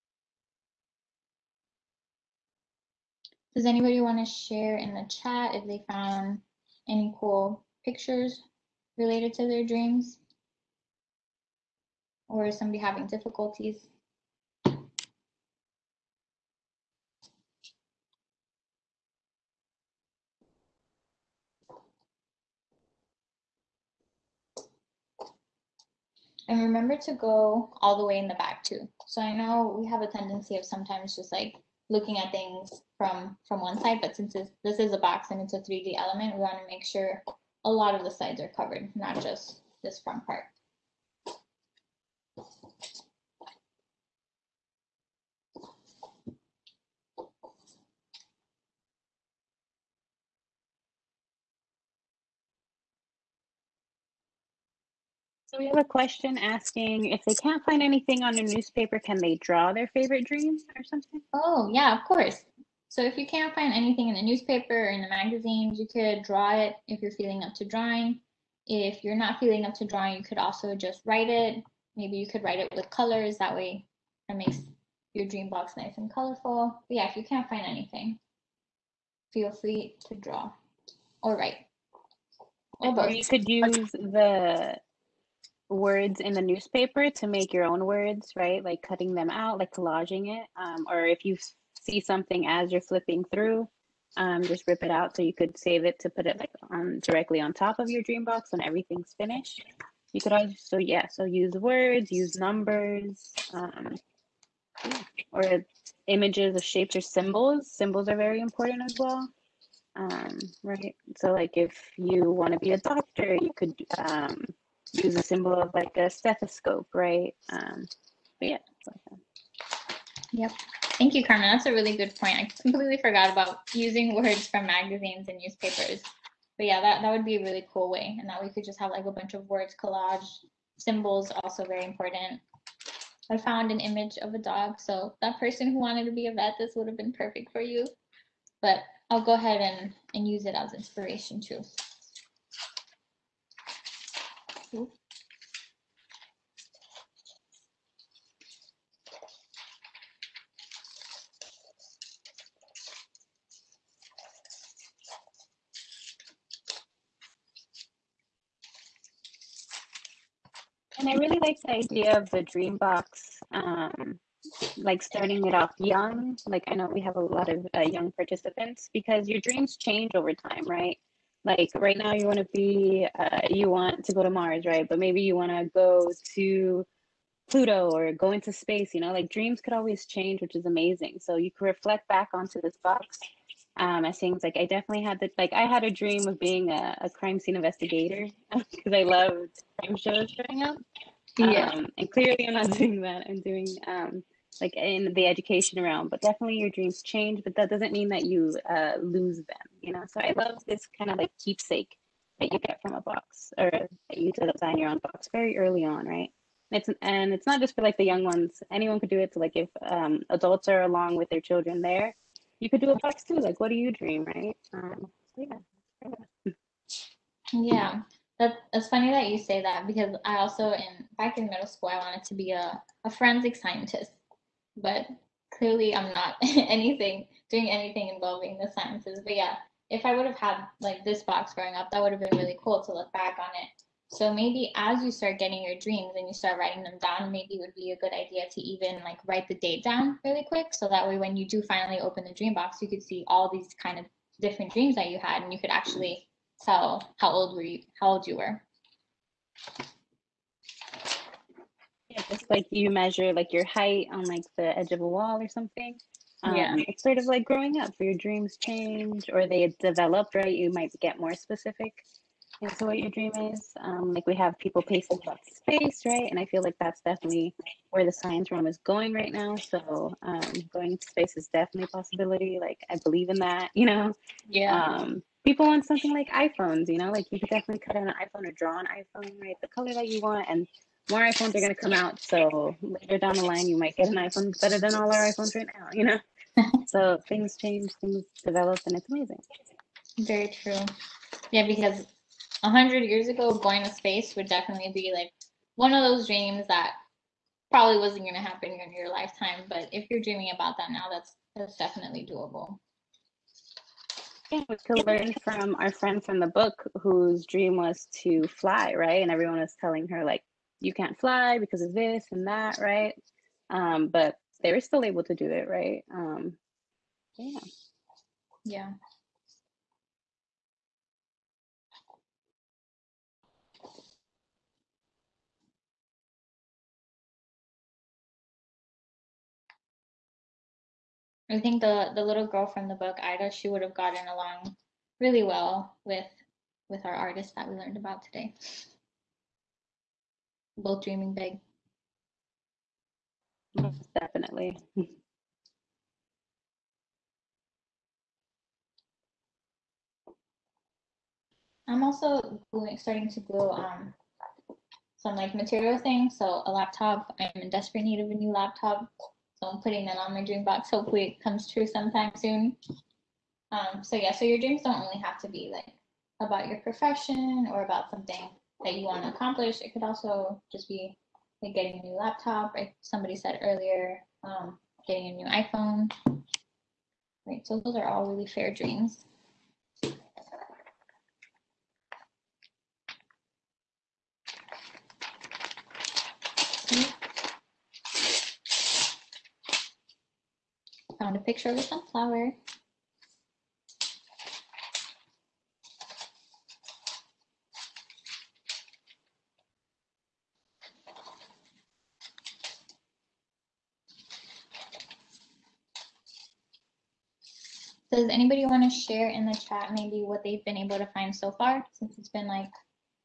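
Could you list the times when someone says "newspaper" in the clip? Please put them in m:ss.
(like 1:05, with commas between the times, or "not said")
0:58, 1:04, 1:26, 2:05.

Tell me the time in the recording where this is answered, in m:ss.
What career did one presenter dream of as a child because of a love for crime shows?
3:07.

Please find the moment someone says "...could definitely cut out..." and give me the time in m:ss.
4:37.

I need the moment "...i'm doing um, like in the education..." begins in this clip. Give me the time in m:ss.
3:13.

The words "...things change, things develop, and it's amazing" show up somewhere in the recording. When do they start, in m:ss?
4:47.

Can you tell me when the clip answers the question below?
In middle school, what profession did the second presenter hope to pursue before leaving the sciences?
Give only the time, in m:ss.
3:43.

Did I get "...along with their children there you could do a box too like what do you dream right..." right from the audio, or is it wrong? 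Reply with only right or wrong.
right.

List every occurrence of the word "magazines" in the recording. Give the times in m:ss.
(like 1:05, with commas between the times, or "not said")
1:05, 2:04.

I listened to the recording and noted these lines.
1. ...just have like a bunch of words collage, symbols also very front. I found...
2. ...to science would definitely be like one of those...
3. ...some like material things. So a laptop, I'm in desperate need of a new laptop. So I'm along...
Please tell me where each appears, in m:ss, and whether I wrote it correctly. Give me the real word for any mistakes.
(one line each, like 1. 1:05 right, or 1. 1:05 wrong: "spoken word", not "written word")
1. 2:08 wrong: "important", not "front"
2. 4:53 wrong: "space", not "science"
3. 5:55 wrong: "putting", not "along".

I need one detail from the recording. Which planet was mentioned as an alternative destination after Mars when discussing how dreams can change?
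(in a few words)
Pluto.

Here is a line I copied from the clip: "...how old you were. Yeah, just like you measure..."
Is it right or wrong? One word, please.
right.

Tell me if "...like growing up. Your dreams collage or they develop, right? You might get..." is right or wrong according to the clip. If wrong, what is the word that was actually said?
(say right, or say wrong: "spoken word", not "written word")
wrong: "change", not "collage".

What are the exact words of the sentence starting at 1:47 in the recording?
Symbols are very important as well.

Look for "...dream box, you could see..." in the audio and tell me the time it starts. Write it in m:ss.
4:02.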